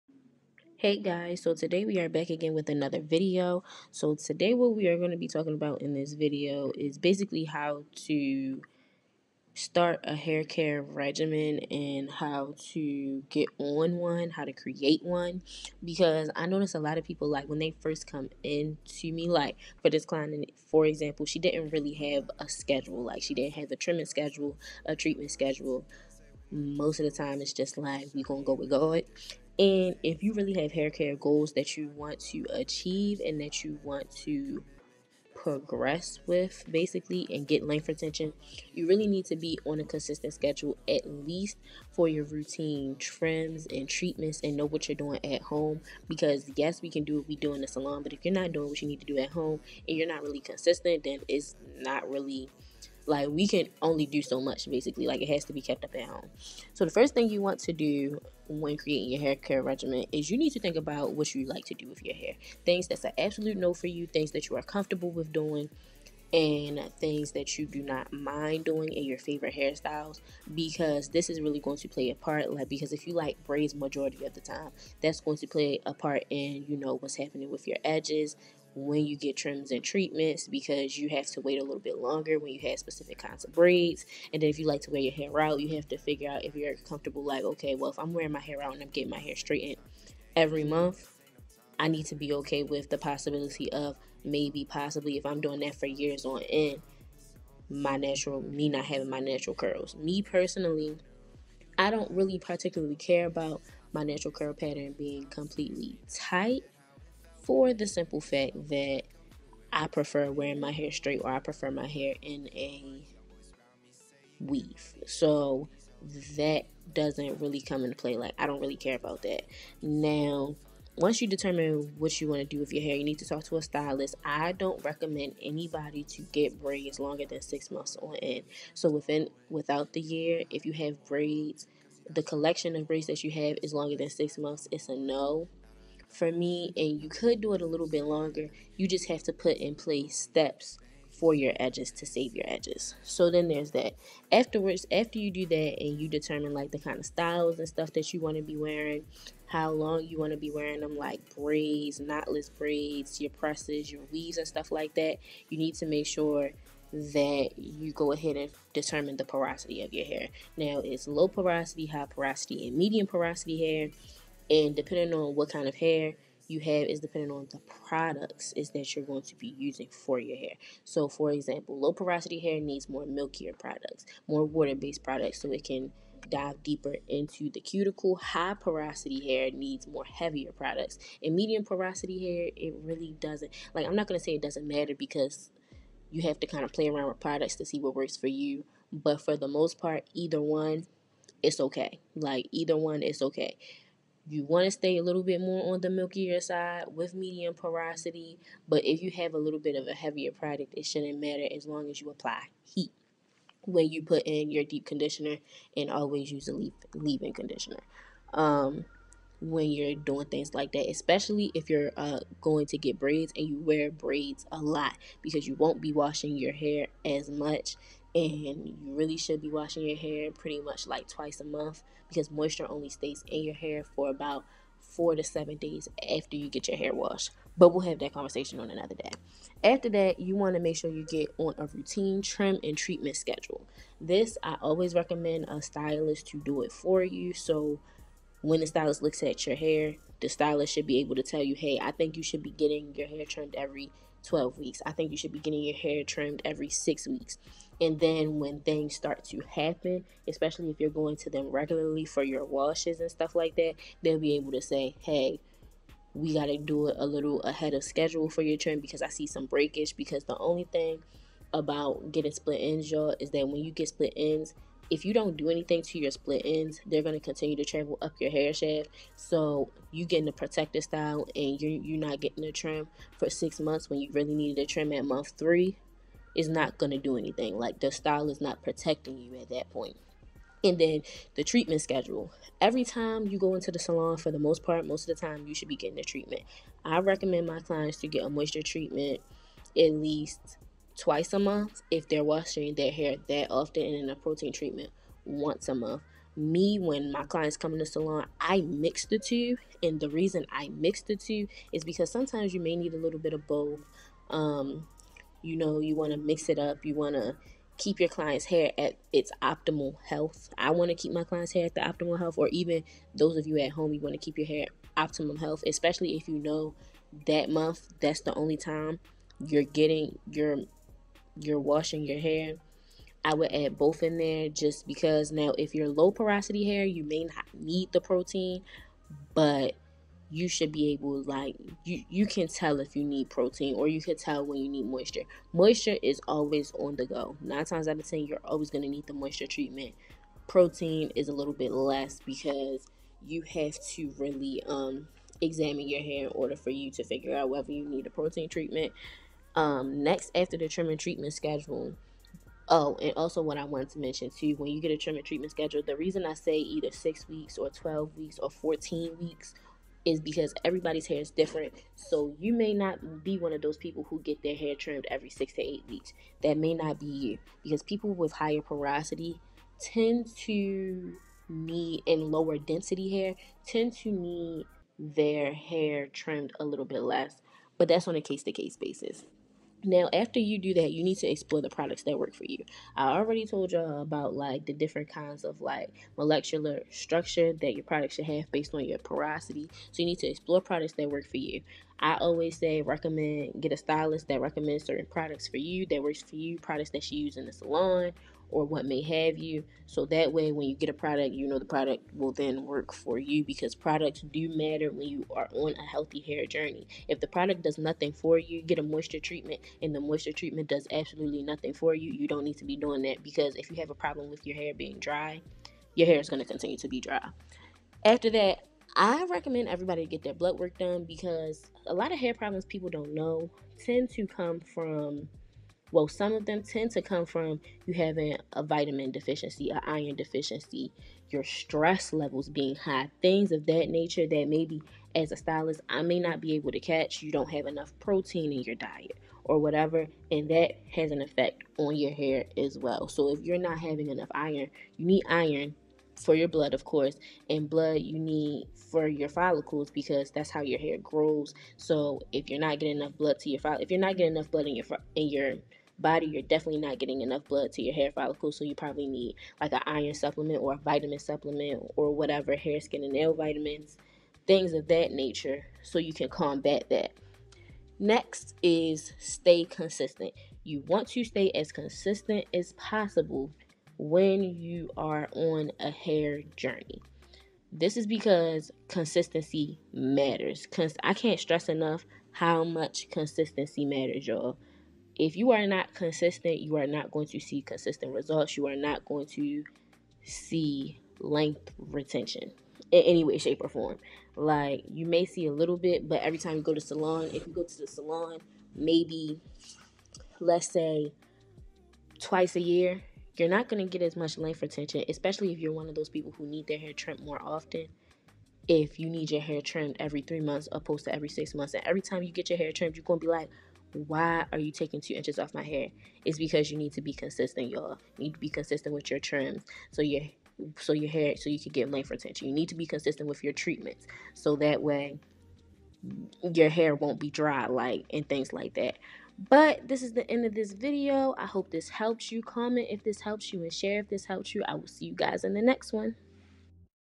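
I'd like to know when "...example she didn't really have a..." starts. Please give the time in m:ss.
0:20.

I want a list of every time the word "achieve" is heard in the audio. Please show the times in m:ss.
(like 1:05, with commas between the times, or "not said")
0:32.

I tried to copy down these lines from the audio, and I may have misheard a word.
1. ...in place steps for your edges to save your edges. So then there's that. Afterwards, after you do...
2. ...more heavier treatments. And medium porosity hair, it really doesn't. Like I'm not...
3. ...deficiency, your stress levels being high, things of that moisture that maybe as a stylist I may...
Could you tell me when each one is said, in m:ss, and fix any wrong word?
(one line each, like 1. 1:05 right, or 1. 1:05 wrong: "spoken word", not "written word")
1. 2:19 right
2. 2:59 wrong: "products", not "treatments"
3. 7:10 wrong: "nature", not "moisture".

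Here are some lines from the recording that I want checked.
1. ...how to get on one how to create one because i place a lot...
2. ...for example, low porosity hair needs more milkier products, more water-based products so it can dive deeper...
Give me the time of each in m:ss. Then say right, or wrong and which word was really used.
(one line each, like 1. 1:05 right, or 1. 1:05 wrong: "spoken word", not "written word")
1. 0:12 wrong: "notice", not "place"
2. 2:51 right.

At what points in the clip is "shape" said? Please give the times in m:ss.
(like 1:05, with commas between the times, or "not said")
8:13.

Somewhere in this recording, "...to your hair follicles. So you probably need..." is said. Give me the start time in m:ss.
7:37.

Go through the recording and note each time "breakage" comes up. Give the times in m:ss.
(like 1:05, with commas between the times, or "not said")
4:19.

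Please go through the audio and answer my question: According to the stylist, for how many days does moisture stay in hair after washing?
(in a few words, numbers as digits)
4 to 7 days.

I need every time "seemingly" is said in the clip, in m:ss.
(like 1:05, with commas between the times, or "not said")
not said.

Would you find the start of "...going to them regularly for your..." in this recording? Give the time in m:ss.
4:10.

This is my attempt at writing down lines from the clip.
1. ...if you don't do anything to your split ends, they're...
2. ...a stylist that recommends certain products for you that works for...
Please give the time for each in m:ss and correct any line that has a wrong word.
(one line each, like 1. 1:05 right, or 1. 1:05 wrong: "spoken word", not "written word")
1. 4:24 right
2. 6:33 right.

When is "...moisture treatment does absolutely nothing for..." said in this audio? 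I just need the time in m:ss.
6:50.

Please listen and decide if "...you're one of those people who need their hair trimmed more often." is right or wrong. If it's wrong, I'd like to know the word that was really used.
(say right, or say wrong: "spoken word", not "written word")
right.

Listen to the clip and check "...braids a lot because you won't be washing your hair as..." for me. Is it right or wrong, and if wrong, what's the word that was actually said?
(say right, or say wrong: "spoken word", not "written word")
right.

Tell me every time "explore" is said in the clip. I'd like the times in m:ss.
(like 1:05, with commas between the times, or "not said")
6:21, 6:30.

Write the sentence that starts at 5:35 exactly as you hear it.
Moisture is always on the go.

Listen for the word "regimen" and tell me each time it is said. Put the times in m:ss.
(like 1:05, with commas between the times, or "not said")
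0:10, 0:59.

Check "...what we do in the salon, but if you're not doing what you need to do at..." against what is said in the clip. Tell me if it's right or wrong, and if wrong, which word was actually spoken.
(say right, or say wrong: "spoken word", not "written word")
right.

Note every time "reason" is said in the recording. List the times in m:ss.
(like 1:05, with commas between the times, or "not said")
5:00, 5:55.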